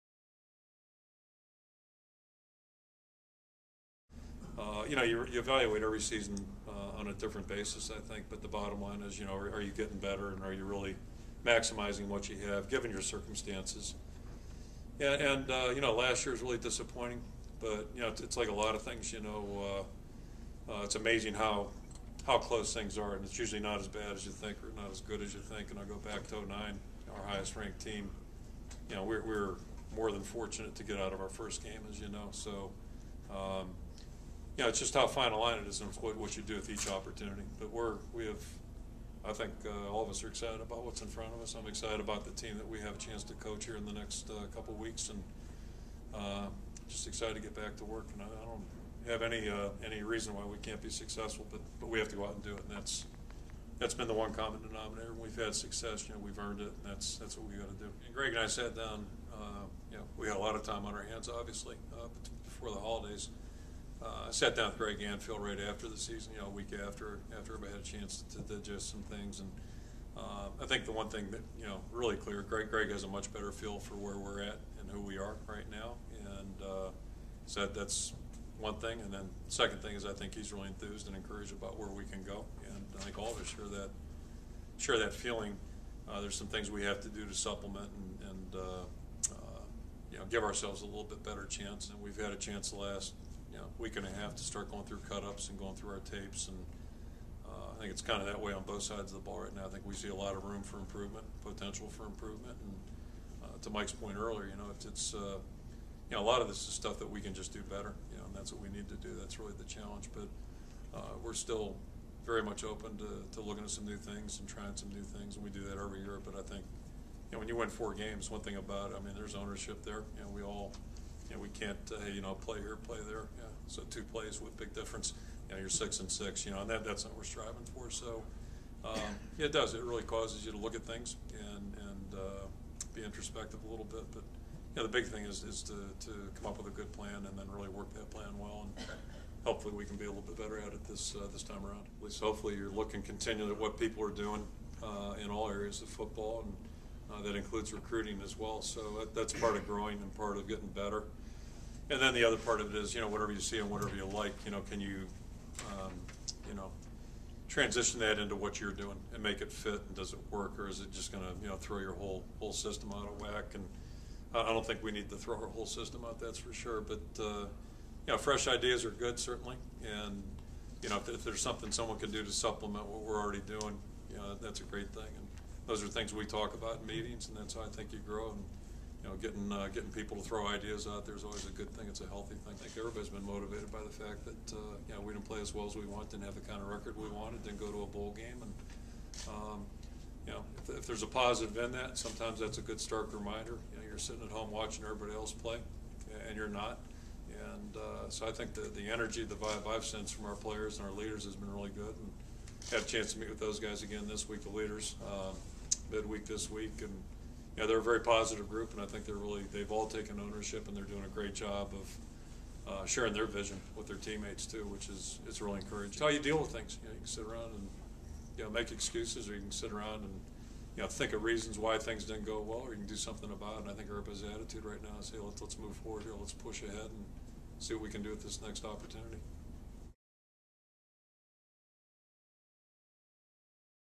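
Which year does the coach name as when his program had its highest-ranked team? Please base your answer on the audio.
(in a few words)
2009.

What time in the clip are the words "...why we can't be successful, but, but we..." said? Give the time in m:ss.
0:50.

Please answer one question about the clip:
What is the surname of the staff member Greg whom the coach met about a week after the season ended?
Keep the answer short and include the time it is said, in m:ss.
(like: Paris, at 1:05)
Anfield, at 1:05.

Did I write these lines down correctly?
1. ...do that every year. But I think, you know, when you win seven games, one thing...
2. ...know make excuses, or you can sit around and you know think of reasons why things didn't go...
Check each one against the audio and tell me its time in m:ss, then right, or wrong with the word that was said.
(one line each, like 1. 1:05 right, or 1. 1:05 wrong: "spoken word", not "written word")
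1. 1:55 wrong: "four", not "seven"
2. 3:38 right.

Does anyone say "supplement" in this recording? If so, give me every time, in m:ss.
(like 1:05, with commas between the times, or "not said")
1:27, 2:52.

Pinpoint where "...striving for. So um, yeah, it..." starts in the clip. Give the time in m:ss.
2:07.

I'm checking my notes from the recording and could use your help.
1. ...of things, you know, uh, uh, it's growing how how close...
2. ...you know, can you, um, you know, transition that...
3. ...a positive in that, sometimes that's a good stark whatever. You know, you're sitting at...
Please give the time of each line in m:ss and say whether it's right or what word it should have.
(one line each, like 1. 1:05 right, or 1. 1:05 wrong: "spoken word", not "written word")
1. 0:18 wrong: "amazing", not "growing"
2. 2:34 right
3. 3:11 wrong: "reminder", not "whatever".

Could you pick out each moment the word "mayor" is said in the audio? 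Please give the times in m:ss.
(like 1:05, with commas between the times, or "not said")
not said.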